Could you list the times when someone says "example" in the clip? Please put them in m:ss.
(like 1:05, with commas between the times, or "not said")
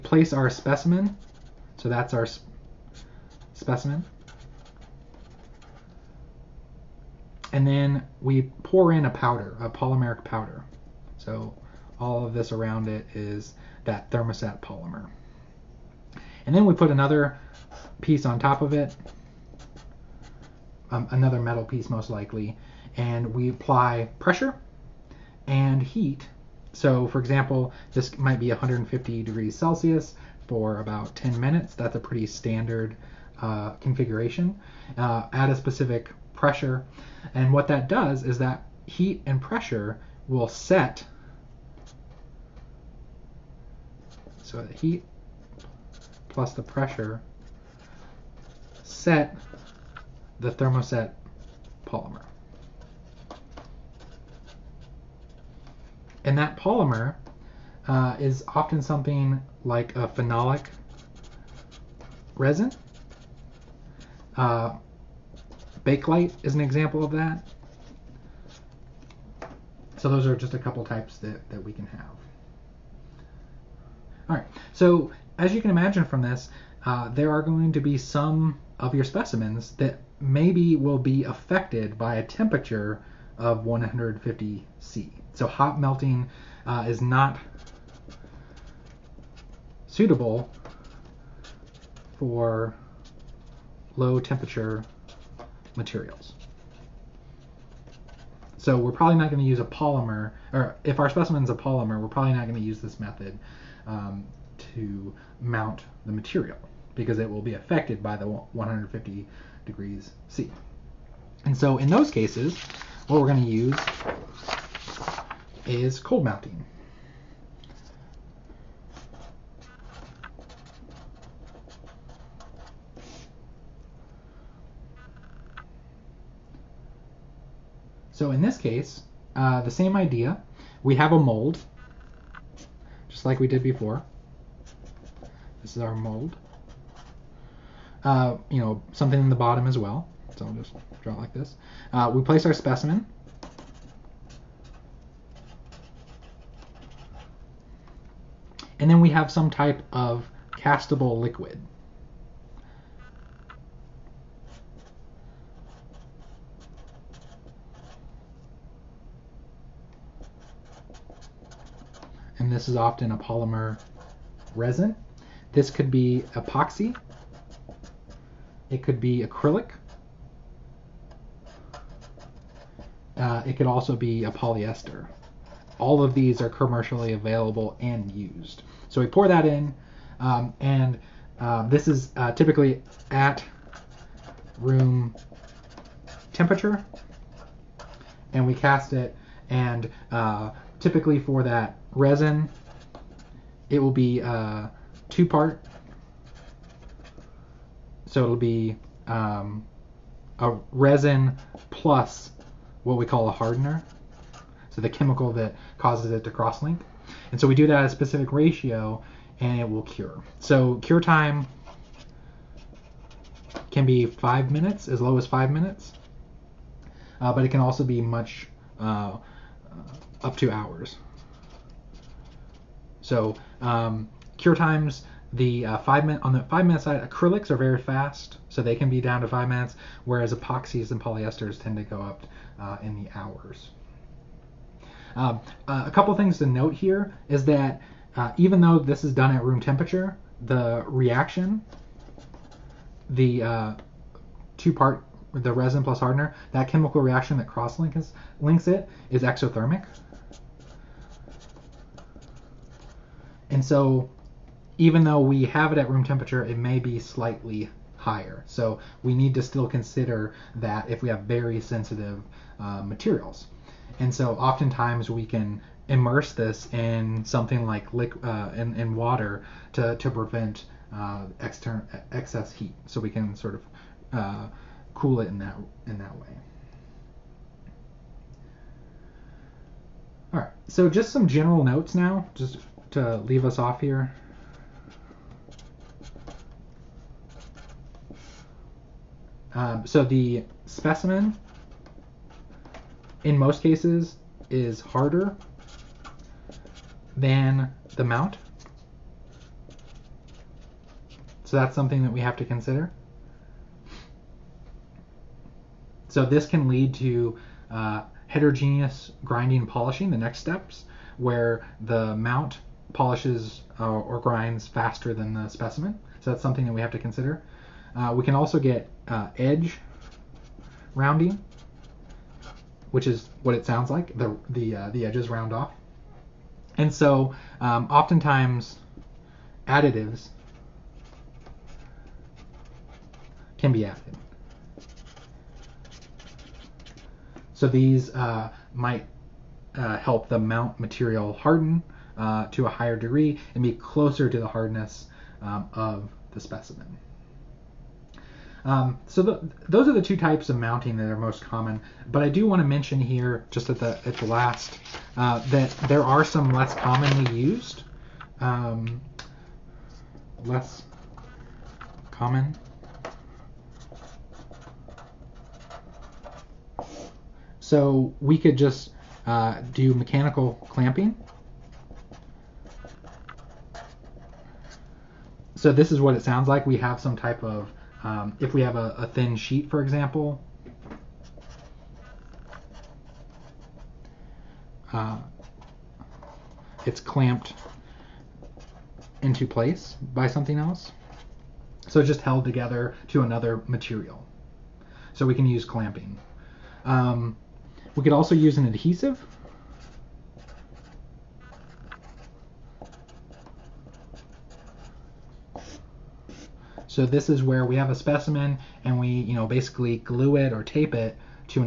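0:27, 1:06, 6:19.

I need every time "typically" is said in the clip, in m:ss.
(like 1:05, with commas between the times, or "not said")
3:02, 3:10.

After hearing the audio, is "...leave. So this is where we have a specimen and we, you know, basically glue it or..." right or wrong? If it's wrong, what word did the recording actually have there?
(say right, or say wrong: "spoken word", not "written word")
wrong: "adhesive", not "leave".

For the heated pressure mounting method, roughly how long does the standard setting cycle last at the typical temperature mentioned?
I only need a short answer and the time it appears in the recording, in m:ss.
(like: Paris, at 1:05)
10 minutes, at 0:31.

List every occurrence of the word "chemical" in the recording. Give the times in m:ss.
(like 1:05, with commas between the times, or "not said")
3:24, 4:06.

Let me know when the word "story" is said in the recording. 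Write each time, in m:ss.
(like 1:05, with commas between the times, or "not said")
not said.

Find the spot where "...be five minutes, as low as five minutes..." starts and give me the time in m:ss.
3:33.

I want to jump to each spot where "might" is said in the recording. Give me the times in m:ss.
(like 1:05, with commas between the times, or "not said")
0:28, 5:38.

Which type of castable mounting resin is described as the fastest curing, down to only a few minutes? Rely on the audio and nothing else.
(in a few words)
acrylics.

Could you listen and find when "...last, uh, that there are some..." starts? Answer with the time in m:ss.
5:54.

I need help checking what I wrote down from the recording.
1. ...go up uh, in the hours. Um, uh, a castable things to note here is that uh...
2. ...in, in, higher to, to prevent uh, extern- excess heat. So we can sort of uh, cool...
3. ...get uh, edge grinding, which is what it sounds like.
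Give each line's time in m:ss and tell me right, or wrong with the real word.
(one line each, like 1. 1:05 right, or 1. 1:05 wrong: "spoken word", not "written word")
1. 3:51 wrong: "couple", not "castable"
2. 4:28 wrong: "water", not "higher"
3. 5:18 wrong: "rounding", not "grinding".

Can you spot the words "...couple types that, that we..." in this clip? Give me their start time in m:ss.
1:10.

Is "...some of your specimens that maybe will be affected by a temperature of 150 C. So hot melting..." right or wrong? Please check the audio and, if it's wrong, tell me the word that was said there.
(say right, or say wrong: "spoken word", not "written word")
right.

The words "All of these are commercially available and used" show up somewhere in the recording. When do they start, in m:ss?
2:55.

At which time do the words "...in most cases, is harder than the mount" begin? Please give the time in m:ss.
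4:53.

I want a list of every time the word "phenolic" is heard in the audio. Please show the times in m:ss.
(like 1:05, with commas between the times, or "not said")
1:00.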